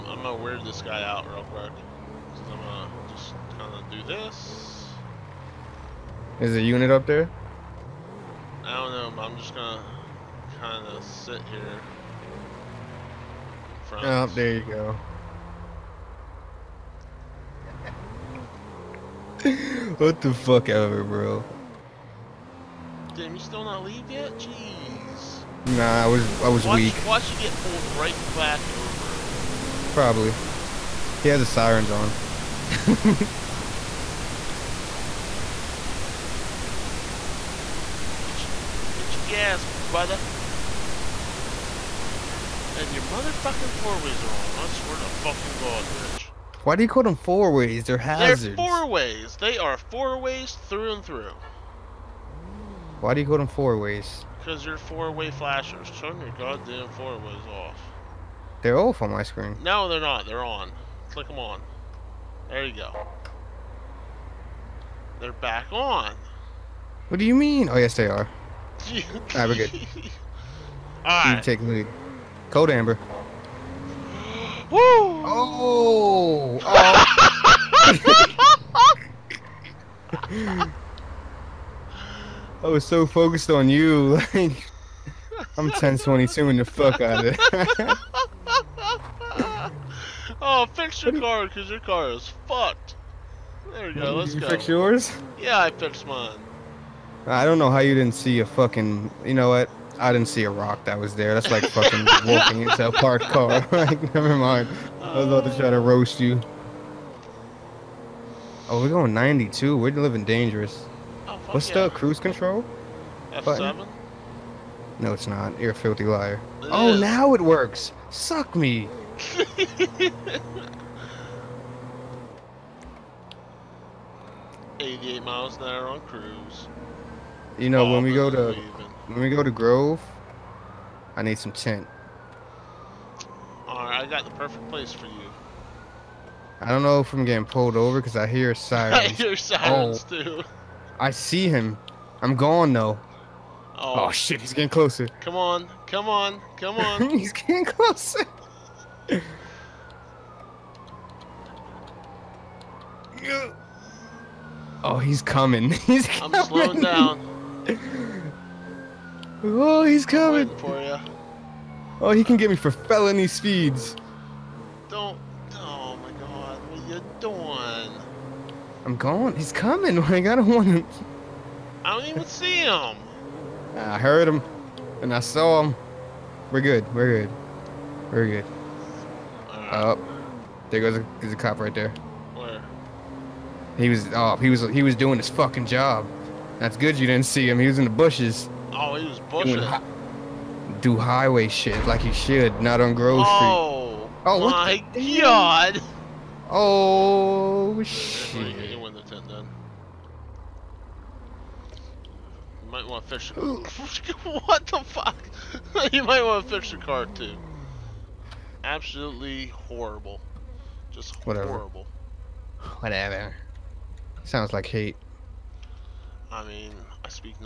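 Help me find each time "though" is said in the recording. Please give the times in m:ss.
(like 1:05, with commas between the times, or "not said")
2:22.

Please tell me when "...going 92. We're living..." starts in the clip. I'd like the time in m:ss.
1:48.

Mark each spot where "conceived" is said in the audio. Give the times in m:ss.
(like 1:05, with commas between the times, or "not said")
not said.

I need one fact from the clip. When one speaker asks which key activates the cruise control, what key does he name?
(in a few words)
F7.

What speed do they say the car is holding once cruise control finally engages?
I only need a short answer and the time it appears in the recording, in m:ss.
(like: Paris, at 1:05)
88 miles an hour, at 2:04.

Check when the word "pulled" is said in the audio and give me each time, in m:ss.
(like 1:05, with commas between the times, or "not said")
0:27, 2:17.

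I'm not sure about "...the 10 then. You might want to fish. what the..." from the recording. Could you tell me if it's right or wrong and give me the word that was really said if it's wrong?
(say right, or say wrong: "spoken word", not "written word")
right.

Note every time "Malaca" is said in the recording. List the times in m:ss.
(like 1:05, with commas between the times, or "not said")
not said.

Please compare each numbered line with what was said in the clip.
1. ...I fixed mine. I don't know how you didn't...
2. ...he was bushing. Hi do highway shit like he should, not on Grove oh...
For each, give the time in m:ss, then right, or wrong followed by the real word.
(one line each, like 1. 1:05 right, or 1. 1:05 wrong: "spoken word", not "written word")
1. 1:35 right
2. 3:08 right.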